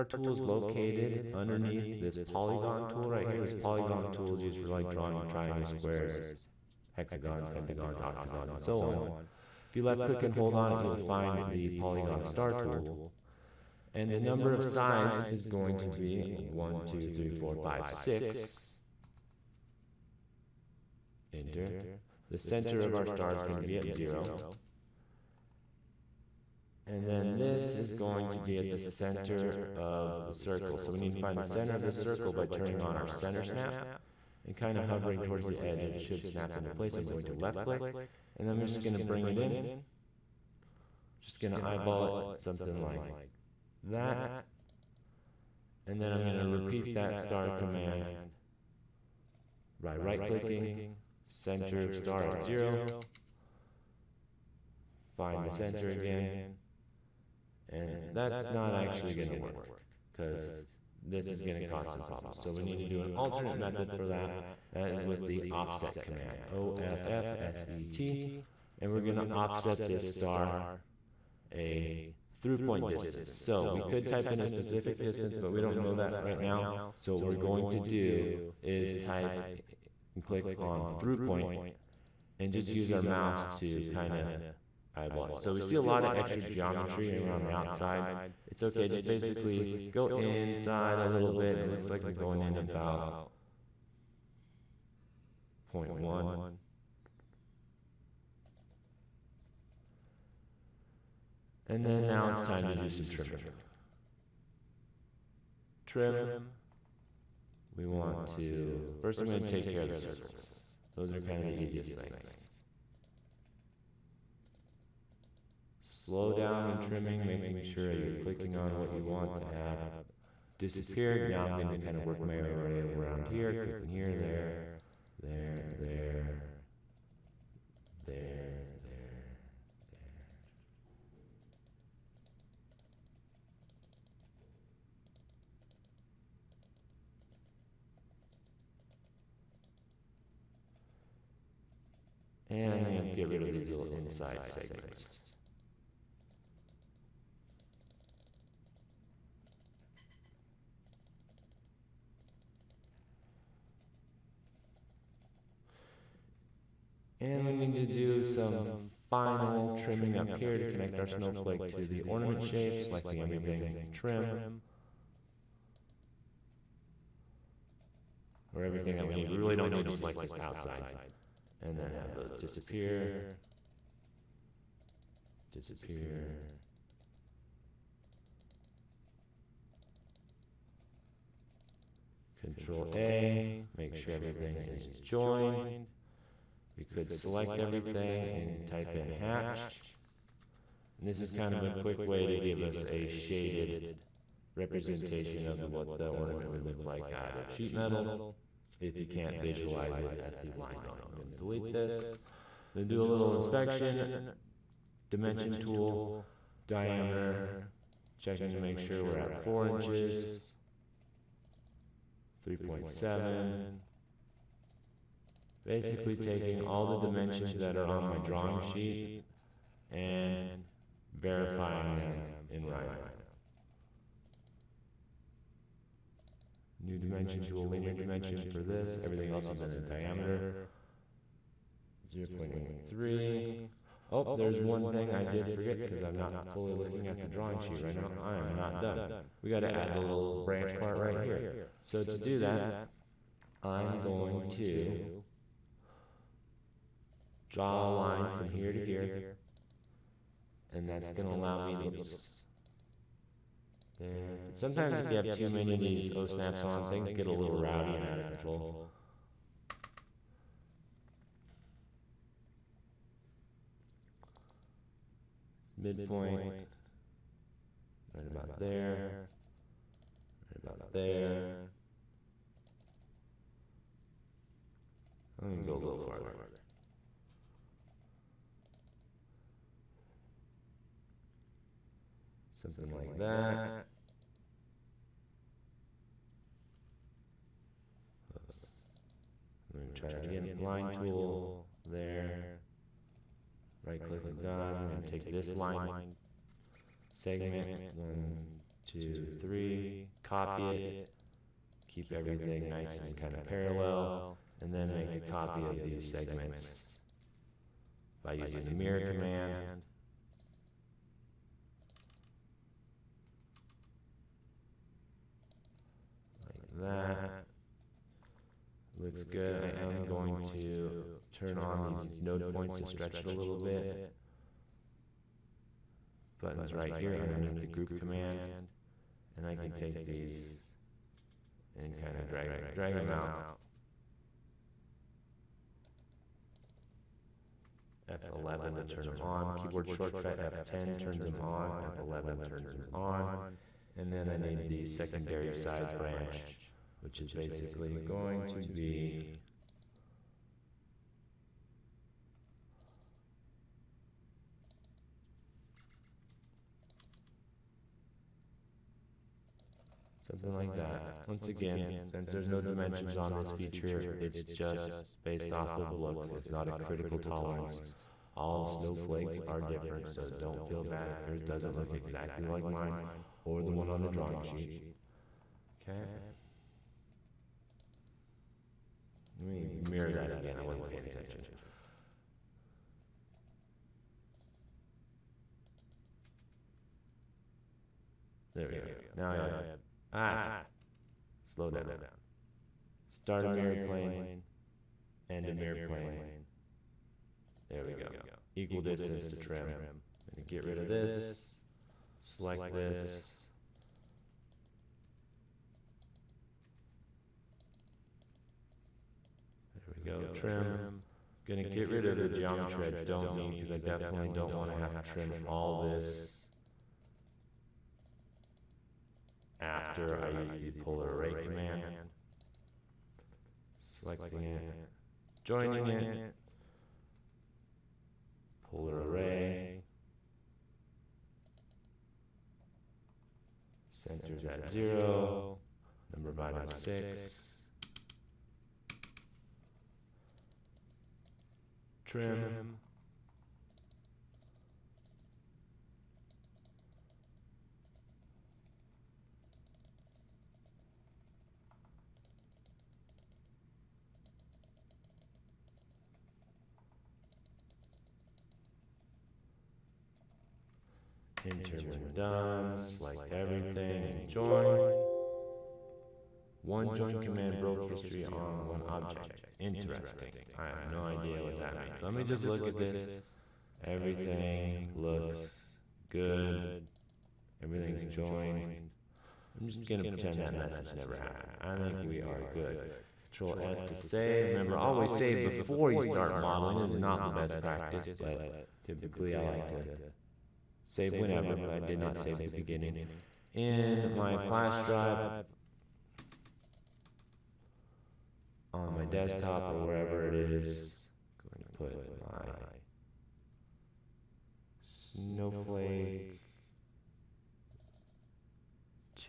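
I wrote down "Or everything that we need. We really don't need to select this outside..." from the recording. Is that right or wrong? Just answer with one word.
right.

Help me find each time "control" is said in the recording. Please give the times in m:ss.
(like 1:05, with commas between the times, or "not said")
3:02, 4:18, 8:03.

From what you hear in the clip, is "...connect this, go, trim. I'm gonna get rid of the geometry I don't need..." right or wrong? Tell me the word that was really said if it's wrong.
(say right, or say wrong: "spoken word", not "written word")
wrong: "select", not "connect".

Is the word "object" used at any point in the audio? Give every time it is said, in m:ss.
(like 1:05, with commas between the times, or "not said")
7:48.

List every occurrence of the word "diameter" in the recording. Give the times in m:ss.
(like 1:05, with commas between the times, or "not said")
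3:26, 3:49.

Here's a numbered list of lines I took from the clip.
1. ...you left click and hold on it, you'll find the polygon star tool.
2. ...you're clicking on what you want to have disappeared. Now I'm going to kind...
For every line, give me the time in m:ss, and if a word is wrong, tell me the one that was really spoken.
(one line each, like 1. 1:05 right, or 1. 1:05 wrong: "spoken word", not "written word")
1. 0:09 right
2. 1:57 right.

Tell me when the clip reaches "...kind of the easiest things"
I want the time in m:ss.
1:51.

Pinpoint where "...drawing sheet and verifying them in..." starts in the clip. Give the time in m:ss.
3:38.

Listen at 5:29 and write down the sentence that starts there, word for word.
And I can take these and kind of drag them, drag them out.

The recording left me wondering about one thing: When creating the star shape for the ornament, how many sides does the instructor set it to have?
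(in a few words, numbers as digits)
6.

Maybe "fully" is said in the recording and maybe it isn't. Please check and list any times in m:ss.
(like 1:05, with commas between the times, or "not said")
3:56.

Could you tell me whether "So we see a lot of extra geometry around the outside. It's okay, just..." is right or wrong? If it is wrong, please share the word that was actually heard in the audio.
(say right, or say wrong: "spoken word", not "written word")
right.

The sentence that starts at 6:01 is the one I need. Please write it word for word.
Once again, since there's no dimensions on this feature, it's just based off of looks.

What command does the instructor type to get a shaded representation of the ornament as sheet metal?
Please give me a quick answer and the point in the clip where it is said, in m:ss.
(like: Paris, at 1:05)
hatch, at 3:09.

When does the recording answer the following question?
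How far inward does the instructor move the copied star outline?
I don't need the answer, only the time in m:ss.
1:35.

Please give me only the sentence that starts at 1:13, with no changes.
So we could type in a specific distance, but we don't know that right now.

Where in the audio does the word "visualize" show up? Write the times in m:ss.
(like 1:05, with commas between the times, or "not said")
3:19.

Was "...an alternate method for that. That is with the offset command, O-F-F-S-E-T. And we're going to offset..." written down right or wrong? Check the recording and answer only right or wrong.
right.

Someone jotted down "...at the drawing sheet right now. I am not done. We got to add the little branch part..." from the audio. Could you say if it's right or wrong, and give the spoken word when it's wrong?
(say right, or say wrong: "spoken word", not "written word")
right.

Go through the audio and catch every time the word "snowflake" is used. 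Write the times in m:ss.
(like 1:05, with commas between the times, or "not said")
2:41, 6:08, 8:24.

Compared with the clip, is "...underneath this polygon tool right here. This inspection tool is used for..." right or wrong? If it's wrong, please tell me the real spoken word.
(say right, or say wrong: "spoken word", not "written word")
wrong: "polygon", not "inspection".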